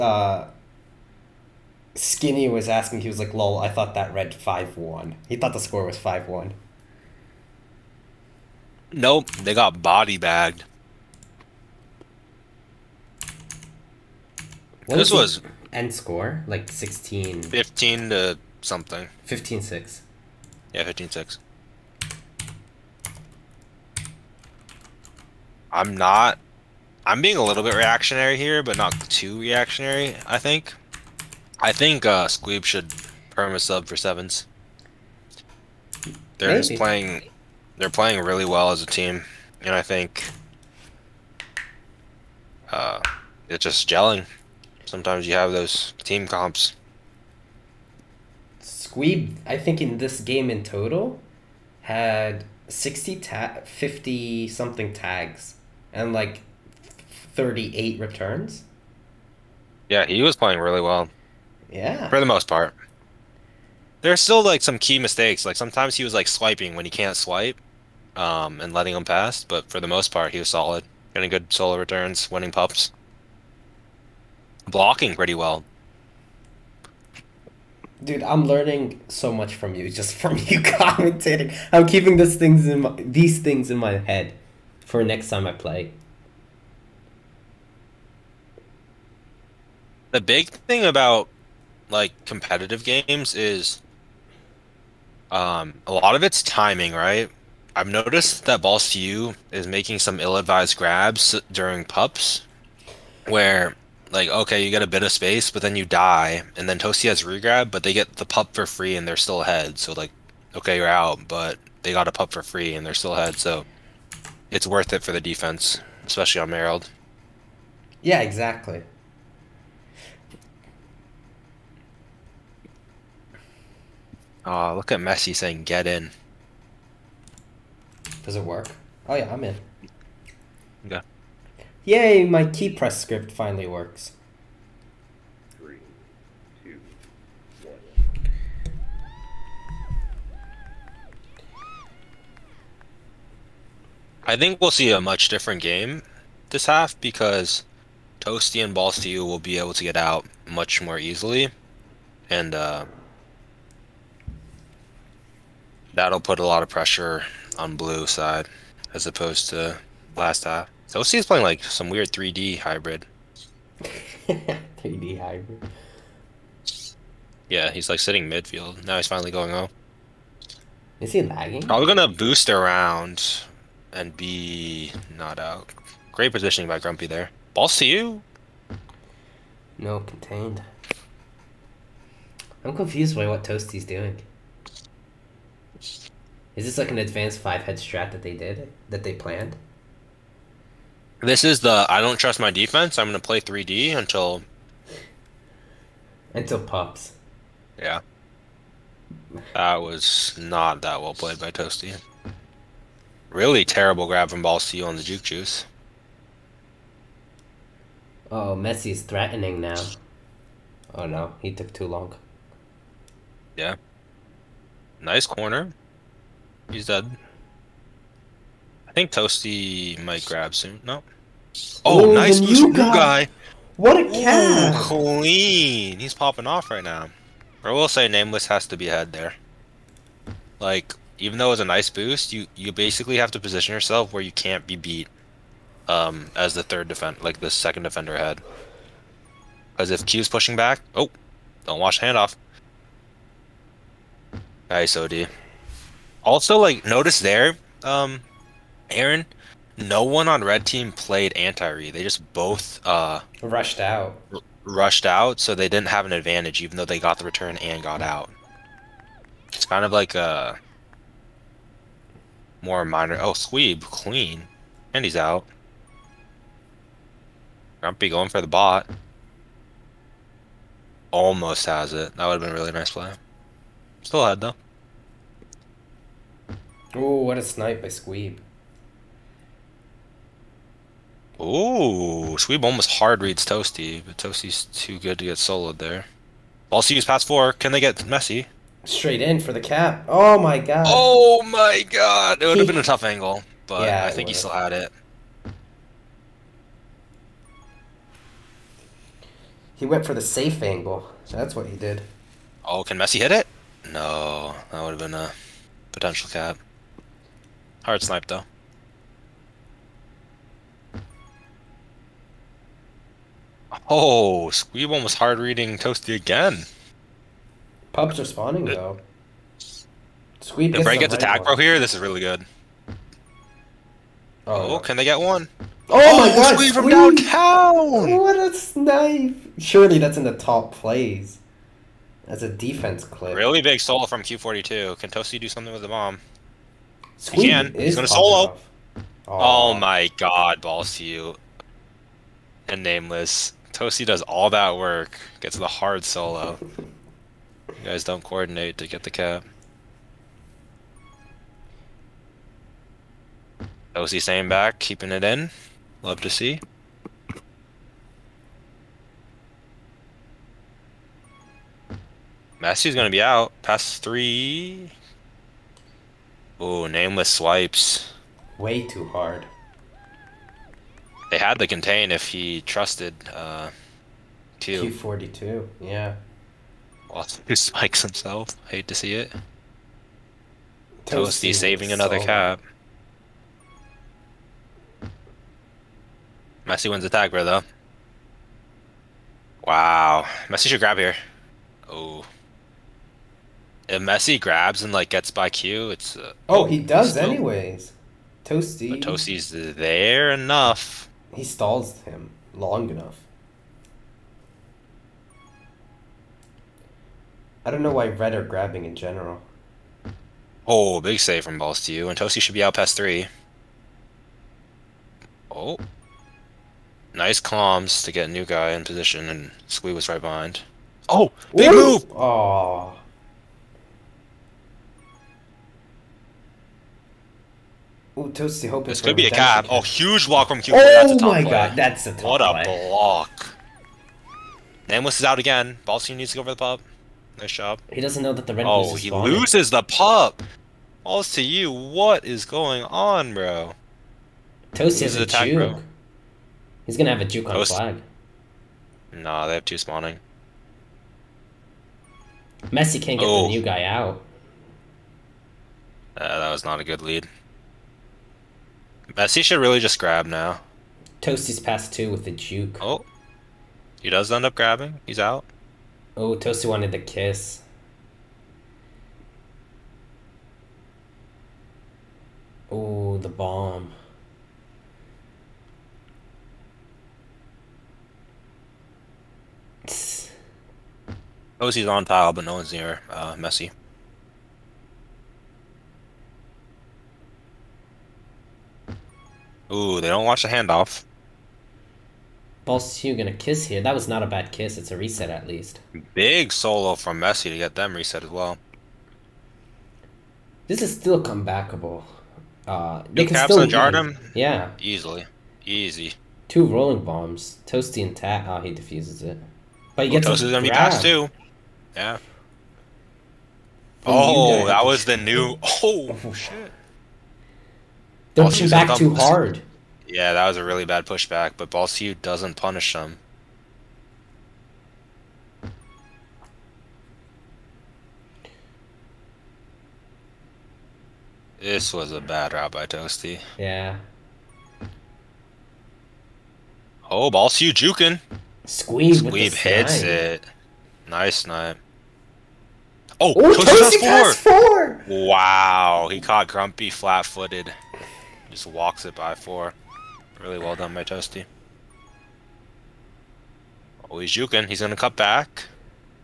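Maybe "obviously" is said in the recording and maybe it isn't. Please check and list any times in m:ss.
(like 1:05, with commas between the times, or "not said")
not said.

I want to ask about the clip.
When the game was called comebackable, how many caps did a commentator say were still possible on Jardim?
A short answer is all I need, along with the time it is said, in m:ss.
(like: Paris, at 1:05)
2, at 8:23.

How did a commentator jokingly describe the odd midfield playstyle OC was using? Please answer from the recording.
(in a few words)
3D hybrid.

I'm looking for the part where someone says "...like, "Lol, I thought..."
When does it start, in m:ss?
0:03.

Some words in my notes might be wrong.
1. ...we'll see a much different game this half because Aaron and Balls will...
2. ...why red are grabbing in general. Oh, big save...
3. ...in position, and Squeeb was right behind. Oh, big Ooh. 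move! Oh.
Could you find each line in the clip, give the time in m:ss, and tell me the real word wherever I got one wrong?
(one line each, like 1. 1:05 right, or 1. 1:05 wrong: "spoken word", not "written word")
1. 2:24 wrong: "Toasty", not "Aaron"
2. 6:47 right
3. 6:58 right.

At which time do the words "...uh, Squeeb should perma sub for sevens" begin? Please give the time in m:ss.
0:32.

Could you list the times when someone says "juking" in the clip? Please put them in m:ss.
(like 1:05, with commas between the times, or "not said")
8:57, 9:14.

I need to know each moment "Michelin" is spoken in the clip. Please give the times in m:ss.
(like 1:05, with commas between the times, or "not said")
not said.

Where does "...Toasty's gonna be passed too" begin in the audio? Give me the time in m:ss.
8:30.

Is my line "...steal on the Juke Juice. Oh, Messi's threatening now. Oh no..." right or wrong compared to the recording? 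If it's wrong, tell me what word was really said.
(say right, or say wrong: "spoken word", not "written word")
right.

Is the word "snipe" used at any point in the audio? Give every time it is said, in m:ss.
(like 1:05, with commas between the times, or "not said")
4:37, 5:08, 5:28, 9:01.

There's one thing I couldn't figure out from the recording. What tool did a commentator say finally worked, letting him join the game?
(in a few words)
key press script.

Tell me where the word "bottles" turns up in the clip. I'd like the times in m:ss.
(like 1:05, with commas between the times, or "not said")
not said.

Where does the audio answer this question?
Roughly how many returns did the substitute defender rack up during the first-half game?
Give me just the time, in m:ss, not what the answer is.
0:57.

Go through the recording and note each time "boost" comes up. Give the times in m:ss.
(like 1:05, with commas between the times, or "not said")
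2:52, 3:51.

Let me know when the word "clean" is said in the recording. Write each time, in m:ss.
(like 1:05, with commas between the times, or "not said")
3:44, 4:23.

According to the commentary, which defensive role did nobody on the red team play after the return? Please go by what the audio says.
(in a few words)
anti-re.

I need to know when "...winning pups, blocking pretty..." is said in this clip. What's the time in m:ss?
1:12.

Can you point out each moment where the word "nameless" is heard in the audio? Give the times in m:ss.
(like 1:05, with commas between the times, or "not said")
3:48, 5:42, 6:06, 7:14.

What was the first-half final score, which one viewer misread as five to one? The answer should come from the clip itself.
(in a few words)
15-6.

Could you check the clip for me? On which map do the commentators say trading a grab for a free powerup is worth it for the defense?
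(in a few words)
Merrill.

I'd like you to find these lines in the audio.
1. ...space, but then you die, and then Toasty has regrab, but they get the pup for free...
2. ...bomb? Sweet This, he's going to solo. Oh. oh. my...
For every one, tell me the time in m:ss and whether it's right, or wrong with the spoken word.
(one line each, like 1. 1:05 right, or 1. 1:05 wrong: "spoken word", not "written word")
1. 1:45 right
2. 5:35 wrong: "Again", not "This".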